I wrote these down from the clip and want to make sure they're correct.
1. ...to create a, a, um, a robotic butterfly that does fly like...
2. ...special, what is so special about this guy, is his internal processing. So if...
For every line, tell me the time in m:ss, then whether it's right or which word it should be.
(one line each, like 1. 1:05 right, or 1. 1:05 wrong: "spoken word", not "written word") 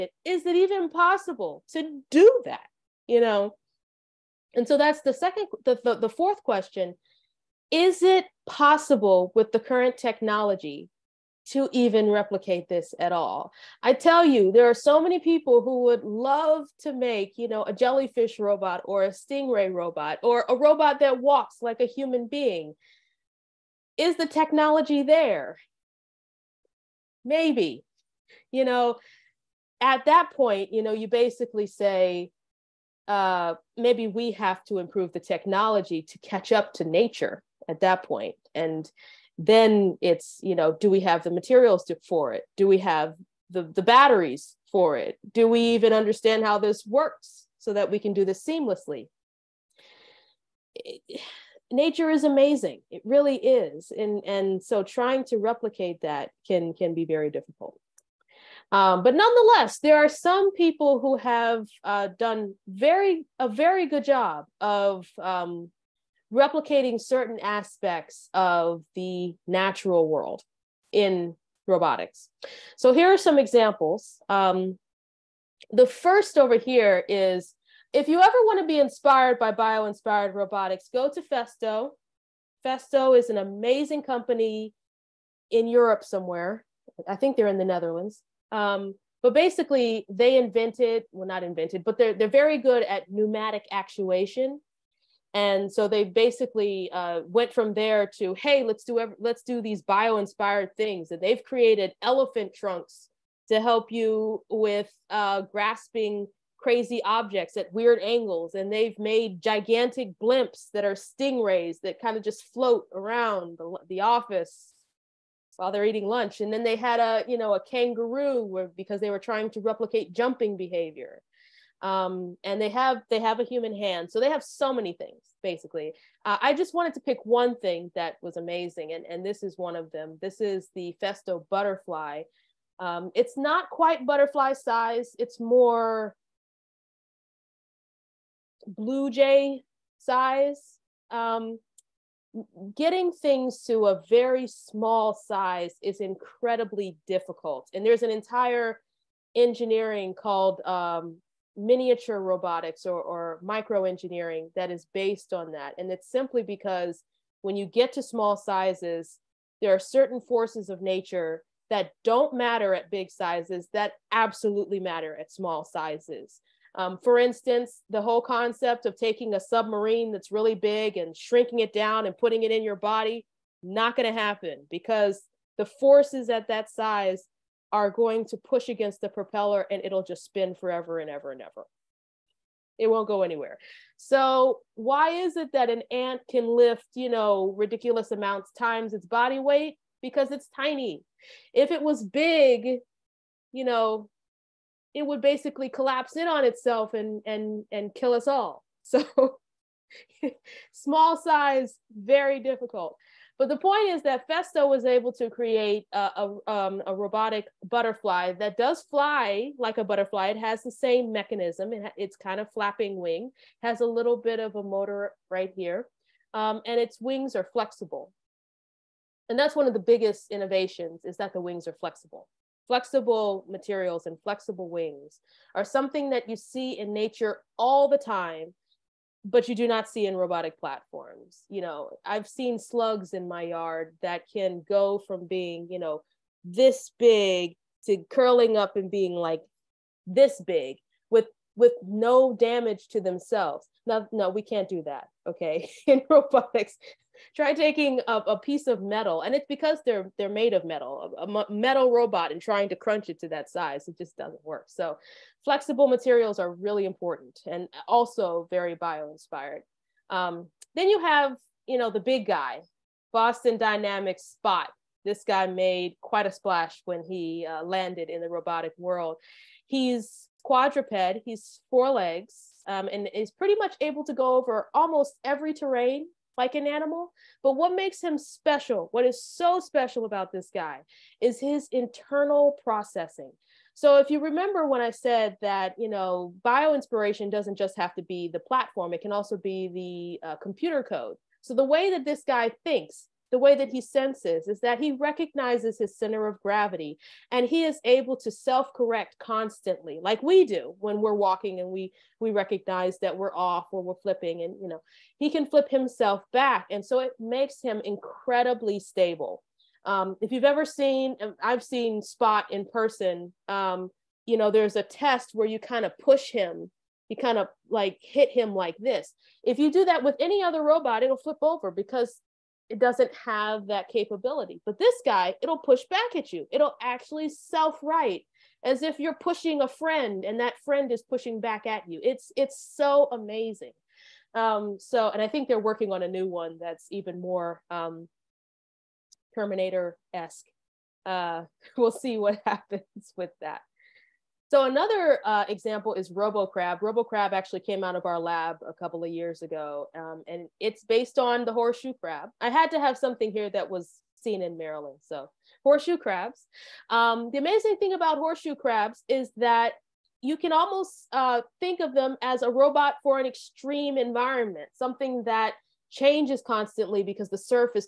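1. 3:25 right
2. 4:38 right.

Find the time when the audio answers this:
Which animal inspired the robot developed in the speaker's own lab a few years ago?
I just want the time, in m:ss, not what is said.
5:51.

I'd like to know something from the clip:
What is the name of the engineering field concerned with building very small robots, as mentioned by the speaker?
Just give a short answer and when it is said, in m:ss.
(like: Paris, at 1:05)
Micro engineering, at 2:33.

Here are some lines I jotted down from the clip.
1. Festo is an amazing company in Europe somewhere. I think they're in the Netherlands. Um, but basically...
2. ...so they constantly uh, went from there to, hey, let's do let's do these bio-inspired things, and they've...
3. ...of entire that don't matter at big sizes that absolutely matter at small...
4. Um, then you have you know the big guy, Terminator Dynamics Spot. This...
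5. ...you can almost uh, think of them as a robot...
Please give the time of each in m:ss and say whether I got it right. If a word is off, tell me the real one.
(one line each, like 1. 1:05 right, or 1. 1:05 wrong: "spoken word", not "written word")
1. 1:22 right
2. 1:35 wrong: "basically", not "constantly"
3. 2:40 wrong: "nature", not "entire"
4. 4:20 wrong: "Boston", not "Terminator"
5. 6:00 right.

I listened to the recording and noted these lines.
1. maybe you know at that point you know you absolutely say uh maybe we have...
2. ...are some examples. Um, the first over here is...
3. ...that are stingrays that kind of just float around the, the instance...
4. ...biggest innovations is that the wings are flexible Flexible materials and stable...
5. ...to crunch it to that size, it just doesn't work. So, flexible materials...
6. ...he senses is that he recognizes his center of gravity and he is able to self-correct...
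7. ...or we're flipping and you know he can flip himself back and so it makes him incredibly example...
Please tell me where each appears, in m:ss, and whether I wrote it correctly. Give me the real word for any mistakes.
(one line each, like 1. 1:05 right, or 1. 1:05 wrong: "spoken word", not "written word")
1. 0:27 wrong: "basically", not "absolutely"
2. 1:13 right
3. 1:50 wrong: "office", not "instance"
4. 3:39 wrong: "flexible", not "stable"
5. 4:12 right
6. 4:53 right
7. 5:03 wrong: "stable", not "example".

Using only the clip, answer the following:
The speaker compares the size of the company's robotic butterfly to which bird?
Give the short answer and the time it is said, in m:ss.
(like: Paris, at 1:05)
Blue jay, at 2:18.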